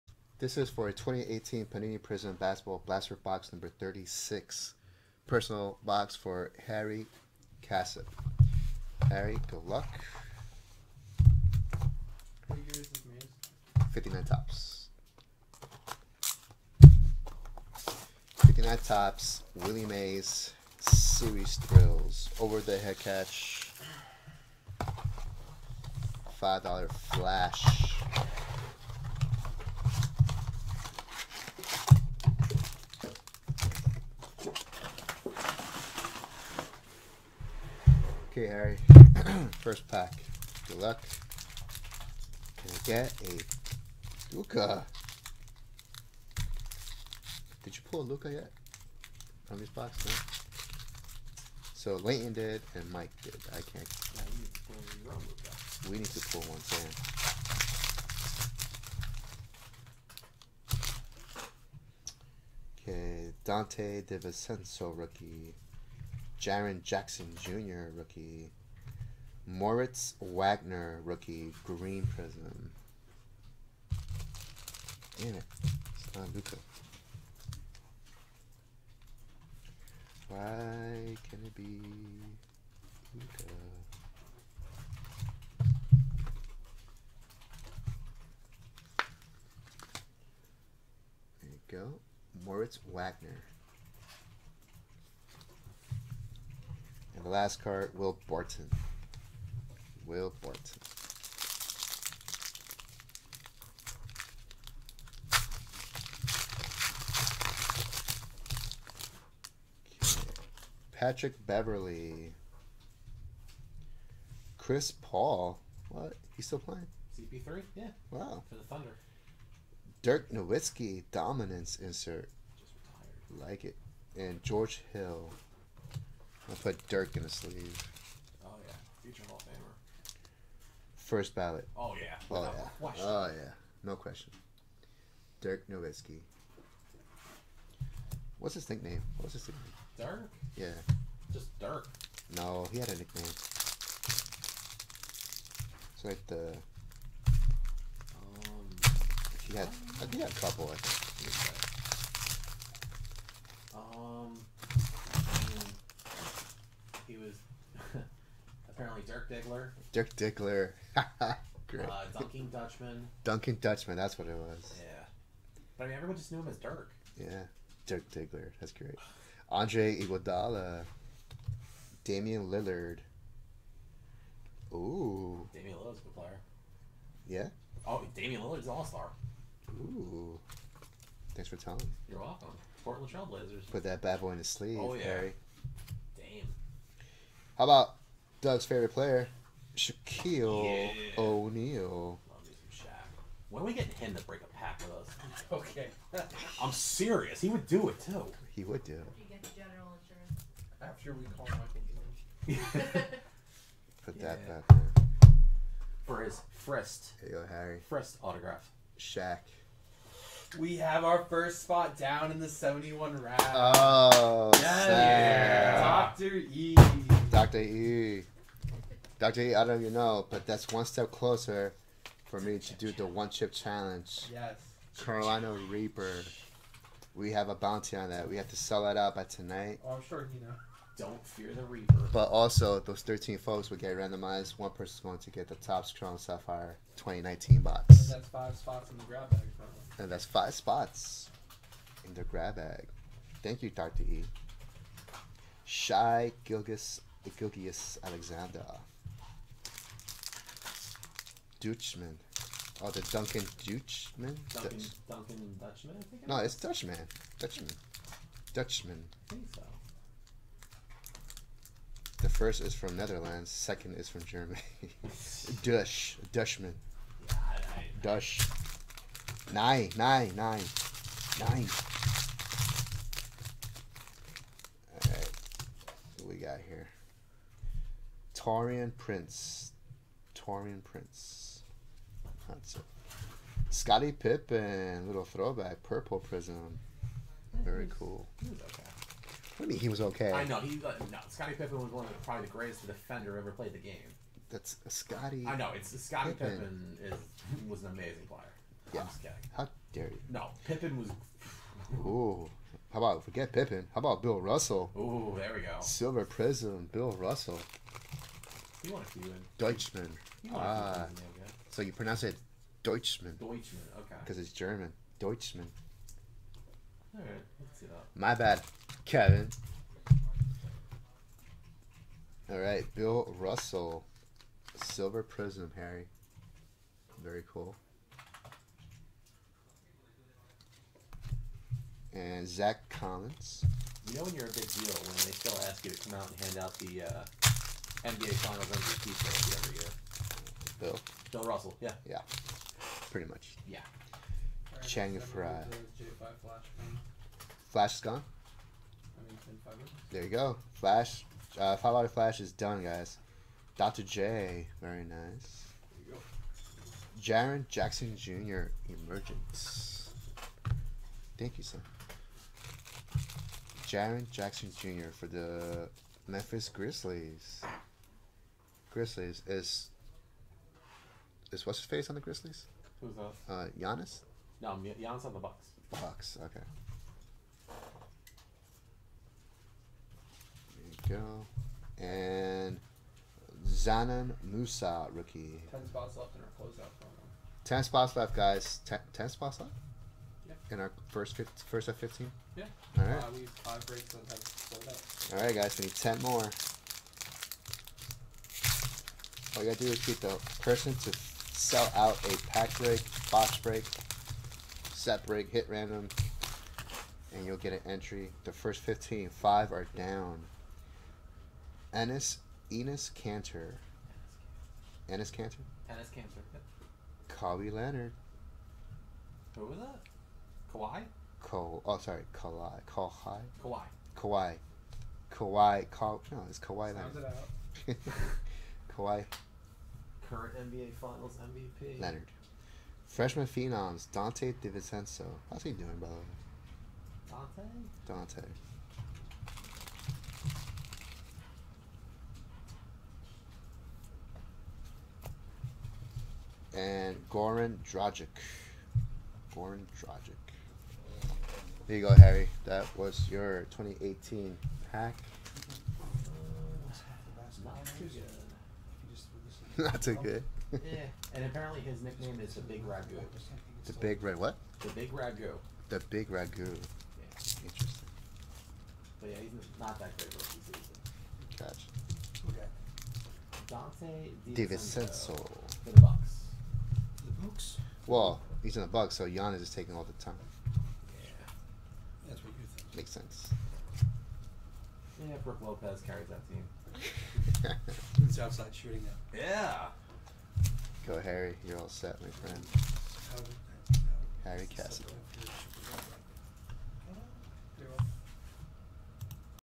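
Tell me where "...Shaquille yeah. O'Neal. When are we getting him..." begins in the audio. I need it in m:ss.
3:09.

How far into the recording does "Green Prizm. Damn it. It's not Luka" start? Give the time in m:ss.
1:11.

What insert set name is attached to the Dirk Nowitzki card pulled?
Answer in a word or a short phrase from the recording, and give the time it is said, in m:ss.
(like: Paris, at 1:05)
Dominance, at 2:01.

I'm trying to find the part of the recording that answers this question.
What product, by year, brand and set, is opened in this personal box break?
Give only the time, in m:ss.
0:00.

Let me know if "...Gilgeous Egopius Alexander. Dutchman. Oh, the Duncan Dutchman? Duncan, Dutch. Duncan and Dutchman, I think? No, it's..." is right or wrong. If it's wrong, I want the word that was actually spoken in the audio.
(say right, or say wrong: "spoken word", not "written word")
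right.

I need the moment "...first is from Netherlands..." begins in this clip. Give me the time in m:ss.
4:22.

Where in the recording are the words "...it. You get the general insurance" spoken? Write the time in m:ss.
3:18.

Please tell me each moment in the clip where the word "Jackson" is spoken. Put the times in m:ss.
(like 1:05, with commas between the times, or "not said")
1:06, 5:57, 6:04.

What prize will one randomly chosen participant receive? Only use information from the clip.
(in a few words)
Topps Chrome Sapphire 2019 box.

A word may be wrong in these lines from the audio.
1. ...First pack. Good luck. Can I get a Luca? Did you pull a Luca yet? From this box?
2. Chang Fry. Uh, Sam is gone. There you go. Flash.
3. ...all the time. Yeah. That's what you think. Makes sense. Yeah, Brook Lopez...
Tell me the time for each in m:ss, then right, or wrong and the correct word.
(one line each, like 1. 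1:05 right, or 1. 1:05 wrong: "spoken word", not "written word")
1. 0:39 right
2. 5:44 wrong: "Flash", not "Sam"
3. 7:59 right.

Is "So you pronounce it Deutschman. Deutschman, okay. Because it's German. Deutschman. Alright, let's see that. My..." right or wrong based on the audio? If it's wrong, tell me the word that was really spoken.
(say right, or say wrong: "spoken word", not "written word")
right.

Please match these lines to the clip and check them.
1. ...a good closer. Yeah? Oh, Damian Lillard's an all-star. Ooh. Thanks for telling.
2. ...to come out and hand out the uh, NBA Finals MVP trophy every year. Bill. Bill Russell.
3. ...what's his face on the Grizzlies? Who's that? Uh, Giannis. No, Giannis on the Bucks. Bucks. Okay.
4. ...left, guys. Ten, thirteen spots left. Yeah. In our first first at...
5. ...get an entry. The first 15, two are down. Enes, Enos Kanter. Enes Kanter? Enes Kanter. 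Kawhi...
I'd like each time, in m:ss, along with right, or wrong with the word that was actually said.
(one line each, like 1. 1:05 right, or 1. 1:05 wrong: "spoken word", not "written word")
1. 2:55 wrong: "player", not "closer"
2. 5:35 right
3. 6:11 right
4. 6:28 wrong: "ten", not "thirteen"
5. 6:47 wrong: "five", not "two".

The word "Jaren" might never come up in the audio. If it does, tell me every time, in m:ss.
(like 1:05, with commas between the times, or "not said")
1:06, 5:57, 6:03.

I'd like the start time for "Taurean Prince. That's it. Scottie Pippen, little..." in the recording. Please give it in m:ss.
4:40.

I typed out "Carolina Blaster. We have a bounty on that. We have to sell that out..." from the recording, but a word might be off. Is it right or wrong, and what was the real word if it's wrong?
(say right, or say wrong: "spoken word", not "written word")
wrong: "Reaper", not "Blaster".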